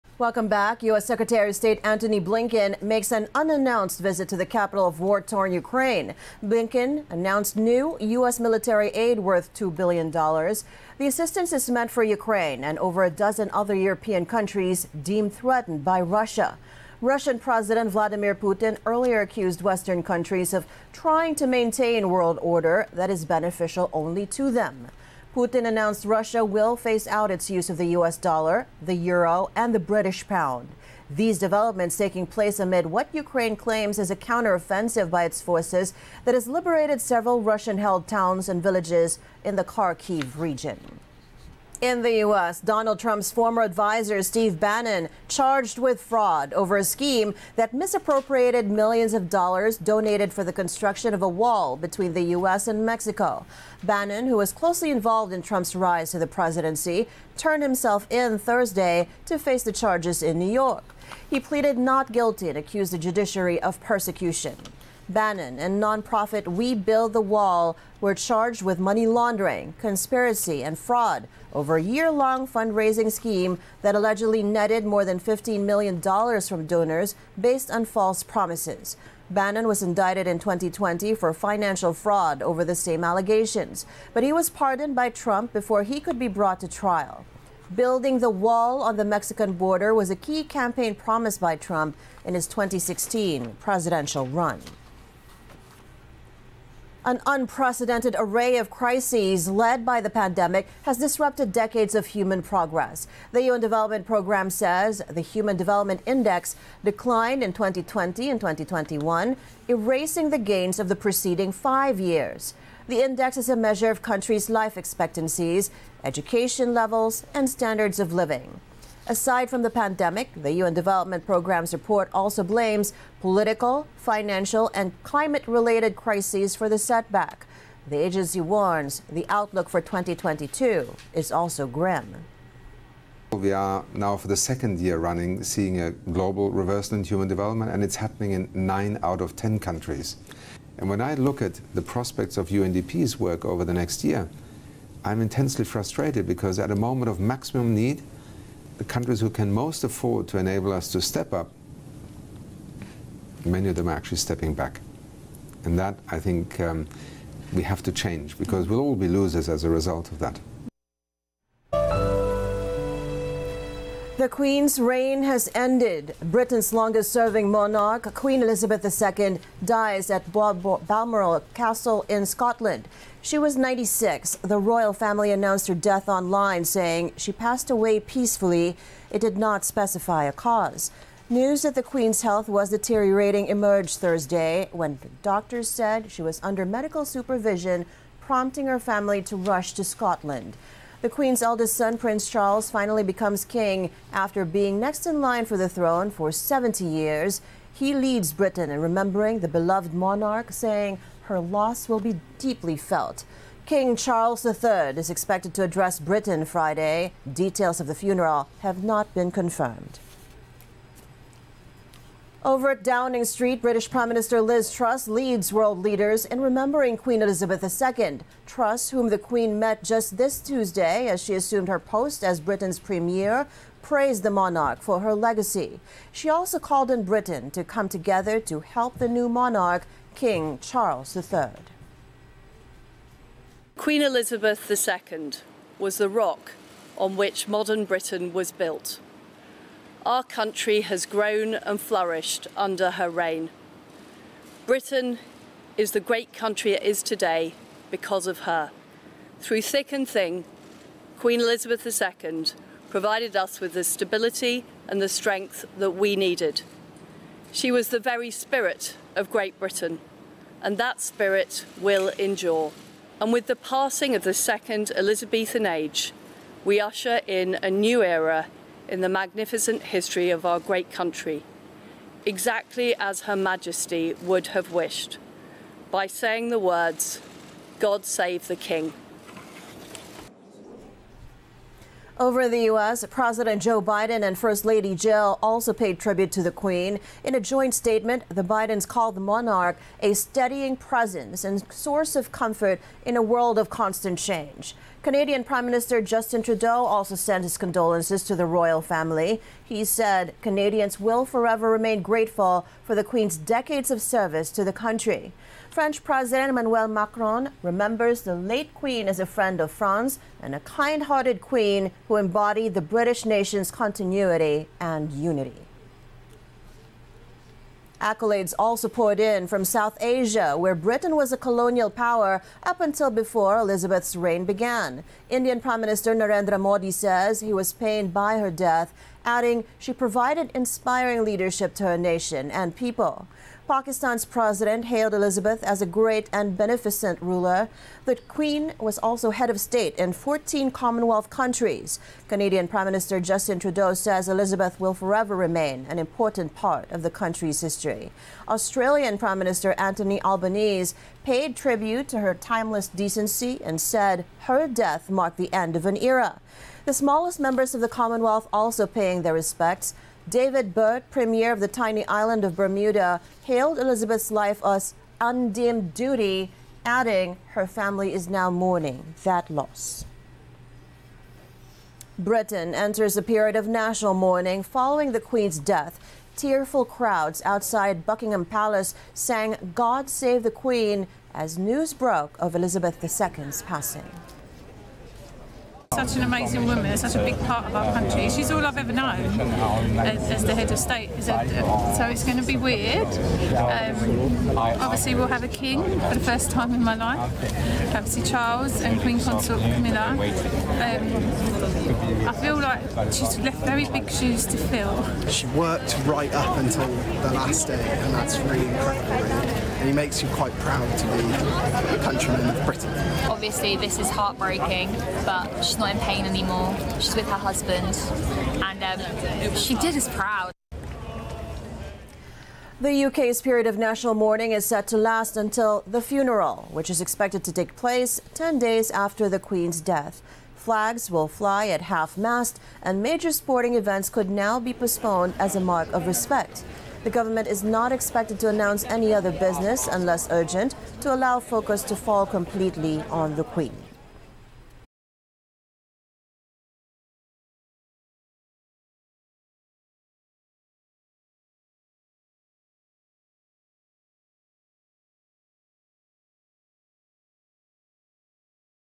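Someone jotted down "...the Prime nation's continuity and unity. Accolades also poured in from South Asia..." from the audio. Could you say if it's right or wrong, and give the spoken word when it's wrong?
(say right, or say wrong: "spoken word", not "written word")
wrong: "British", not "Prime".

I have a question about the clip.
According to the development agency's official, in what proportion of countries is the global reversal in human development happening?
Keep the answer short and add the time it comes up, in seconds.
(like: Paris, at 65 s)
9 out of 10, at 138 s.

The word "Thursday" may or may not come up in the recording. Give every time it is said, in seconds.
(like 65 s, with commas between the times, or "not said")
58 s, 183 s.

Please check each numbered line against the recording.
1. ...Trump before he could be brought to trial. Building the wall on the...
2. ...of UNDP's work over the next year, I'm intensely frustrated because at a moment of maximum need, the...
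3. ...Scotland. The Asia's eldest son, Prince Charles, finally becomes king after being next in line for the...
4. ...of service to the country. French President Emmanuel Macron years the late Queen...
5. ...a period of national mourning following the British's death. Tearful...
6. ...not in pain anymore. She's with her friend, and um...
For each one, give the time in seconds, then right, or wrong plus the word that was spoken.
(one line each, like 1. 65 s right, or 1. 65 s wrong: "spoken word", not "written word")
1. 85 s right
2. 142 s right
3. 189 s wrong: "Queen", not "Asia"
4. 303 s wrong: "remembers", not "years"
5. 373 s wrong: "Queen", not "British"
6. 415 s wrong: "husband", not "friend".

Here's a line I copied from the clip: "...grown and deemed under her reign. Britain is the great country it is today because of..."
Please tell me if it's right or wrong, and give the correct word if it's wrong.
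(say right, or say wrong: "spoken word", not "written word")
wrong: "flourished", not "deemed".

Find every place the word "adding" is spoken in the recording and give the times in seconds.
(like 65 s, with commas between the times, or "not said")
329 s, 366 s.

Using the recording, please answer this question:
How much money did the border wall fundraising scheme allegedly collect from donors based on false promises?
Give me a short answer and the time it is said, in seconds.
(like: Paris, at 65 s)
More than $15 million, at 74 s.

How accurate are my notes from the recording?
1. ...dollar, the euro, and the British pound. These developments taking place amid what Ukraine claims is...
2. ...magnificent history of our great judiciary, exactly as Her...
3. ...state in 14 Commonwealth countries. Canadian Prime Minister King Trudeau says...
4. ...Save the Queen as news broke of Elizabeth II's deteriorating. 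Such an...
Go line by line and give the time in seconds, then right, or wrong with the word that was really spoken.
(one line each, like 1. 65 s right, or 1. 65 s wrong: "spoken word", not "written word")
1. 28 s right
2. 269 s wrong: "country", not "judiciary"
3. 339 s wrong: "Justin", not "King"
4. 380 s wrong: "passing", not "deteriorating".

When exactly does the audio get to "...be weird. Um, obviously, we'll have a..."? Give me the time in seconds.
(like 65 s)
392 s.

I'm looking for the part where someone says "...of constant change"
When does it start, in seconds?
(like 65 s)
293 s.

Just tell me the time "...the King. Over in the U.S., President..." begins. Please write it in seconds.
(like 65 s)
278 s.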